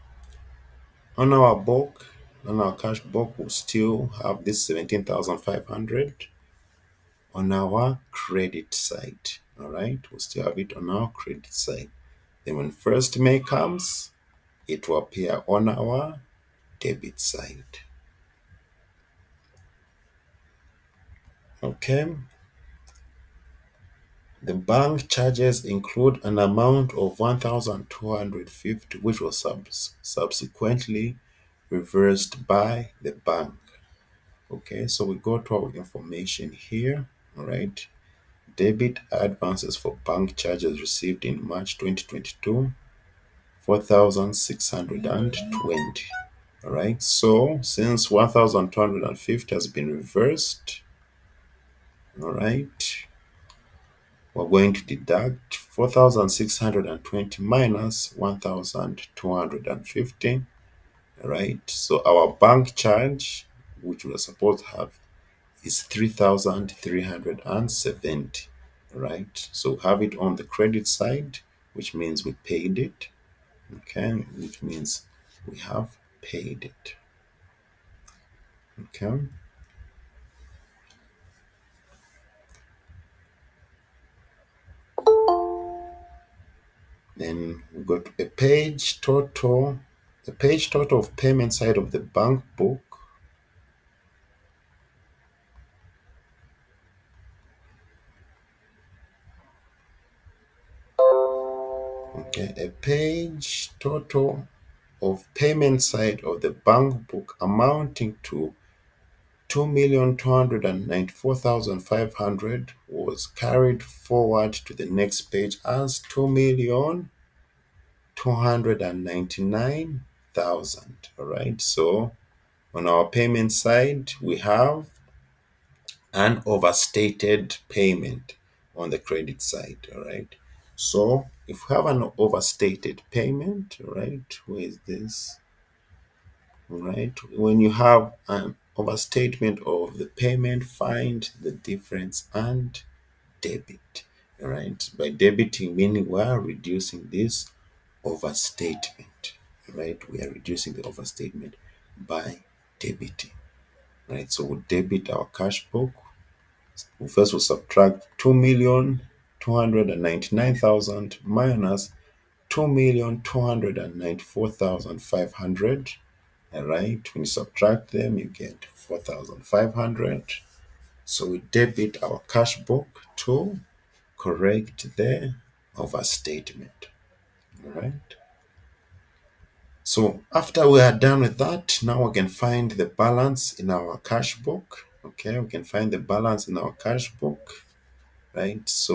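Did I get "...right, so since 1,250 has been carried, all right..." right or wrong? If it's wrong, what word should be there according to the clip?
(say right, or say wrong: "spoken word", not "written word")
wrong: "reversed", not "carried".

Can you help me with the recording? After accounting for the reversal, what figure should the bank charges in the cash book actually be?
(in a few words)
3,370.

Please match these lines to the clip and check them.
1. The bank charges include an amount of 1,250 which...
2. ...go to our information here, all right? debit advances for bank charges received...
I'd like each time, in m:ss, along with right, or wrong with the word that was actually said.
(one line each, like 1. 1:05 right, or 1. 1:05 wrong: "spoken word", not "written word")
1. 0:24 right
2. 0:35 right.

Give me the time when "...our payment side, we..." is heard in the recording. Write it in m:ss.
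2:02.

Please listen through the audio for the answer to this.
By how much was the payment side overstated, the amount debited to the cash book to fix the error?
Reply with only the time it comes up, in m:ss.
2:48.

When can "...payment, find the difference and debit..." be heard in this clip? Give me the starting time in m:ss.
2:20.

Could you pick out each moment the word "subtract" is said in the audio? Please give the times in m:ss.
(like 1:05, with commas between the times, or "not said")
2:37, 2:47.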